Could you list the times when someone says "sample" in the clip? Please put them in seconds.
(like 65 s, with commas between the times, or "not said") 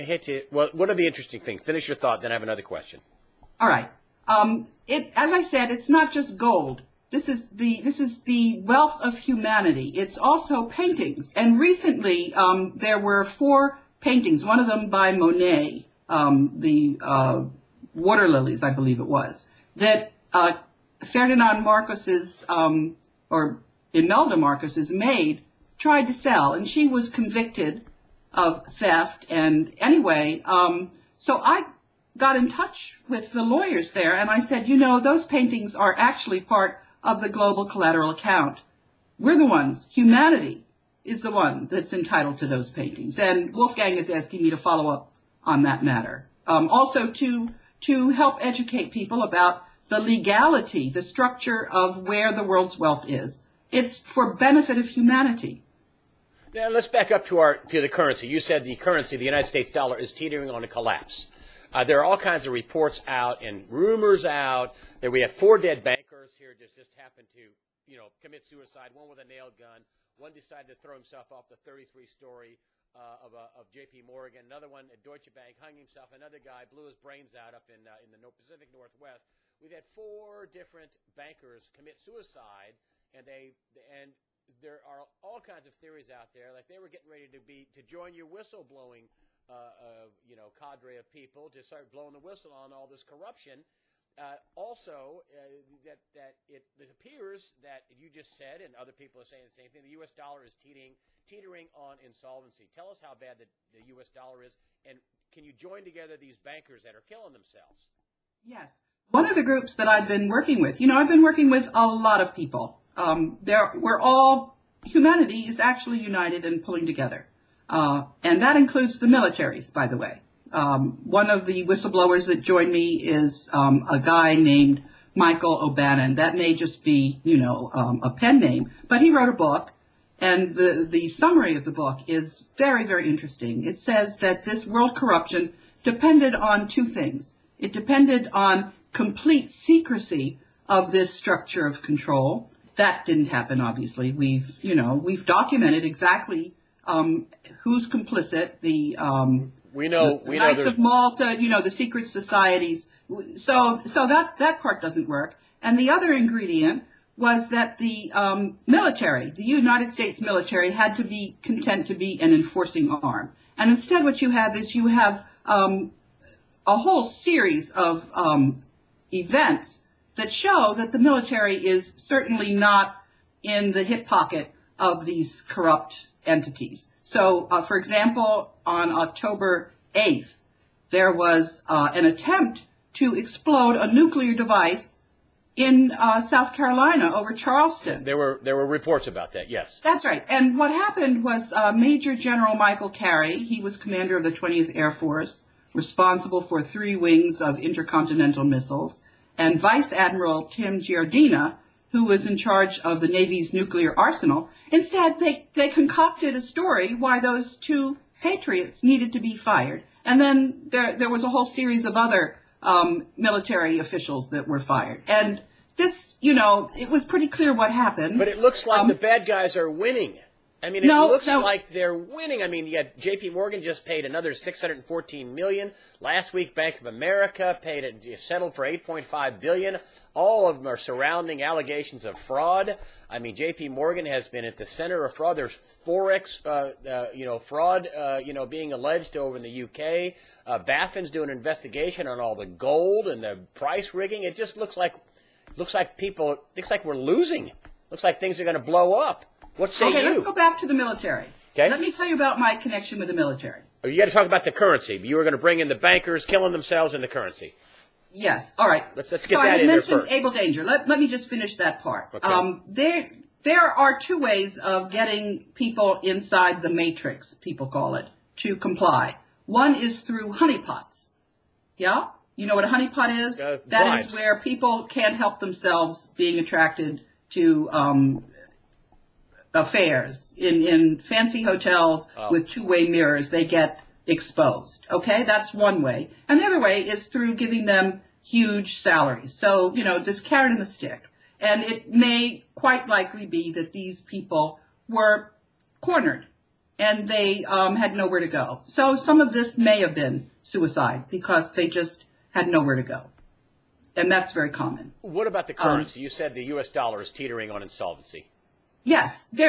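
not said.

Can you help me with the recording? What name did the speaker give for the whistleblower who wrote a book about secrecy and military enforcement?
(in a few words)
Michael O'Bannon.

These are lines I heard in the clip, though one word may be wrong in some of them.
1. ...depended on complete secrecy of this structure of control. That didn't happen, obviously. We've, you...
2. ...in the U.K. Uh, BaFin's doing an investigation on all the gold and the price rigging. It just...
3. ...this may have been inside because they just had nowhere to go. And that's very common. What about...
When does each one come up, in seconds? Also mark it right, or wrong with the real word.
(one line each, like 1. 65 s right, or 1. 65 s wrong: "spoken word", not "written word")
1. 137 s right
2. 239 s right
3. 299 s wrong: "suicide", not "inside".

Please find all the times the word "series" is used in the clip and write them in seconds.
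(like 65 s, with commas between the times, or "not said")
167 s, 211 s.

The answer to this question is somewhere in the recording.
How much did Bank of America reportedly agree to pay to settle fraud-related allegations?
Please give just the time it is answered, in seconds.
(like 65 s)
228 s.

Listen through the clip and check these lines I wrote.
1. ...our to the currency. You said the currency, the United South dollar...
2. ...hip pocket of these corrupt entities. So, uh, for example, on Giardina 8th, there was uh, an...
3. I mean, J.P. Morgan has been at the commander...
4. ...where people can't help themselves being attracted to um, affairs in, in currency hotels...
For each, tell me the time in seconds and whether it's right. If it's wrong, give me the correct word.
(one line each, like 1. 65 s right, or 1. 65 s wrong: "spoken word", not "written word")
1. 57 s wrong: "States", not "South"
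2. 173 s wrong: "October", not "Giardina"
3. 233 s wrong: "center", not "commander"
4. 274 s wrong: "fancy", not "currency".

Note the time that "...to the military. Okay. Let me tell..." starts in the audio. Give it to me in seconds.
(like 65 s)
250 s.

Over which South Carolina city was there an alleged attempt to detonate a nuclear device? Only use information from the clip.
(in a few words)
Charleston.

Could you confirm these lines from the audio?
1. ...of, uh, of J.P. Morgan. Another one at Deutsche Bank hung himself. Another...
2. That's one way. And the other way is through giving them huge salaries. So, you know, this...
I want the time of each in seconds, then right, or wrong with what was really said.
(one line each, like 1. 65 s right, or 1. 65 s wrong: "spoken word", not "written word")
1. 72 s right
2. 285 s right.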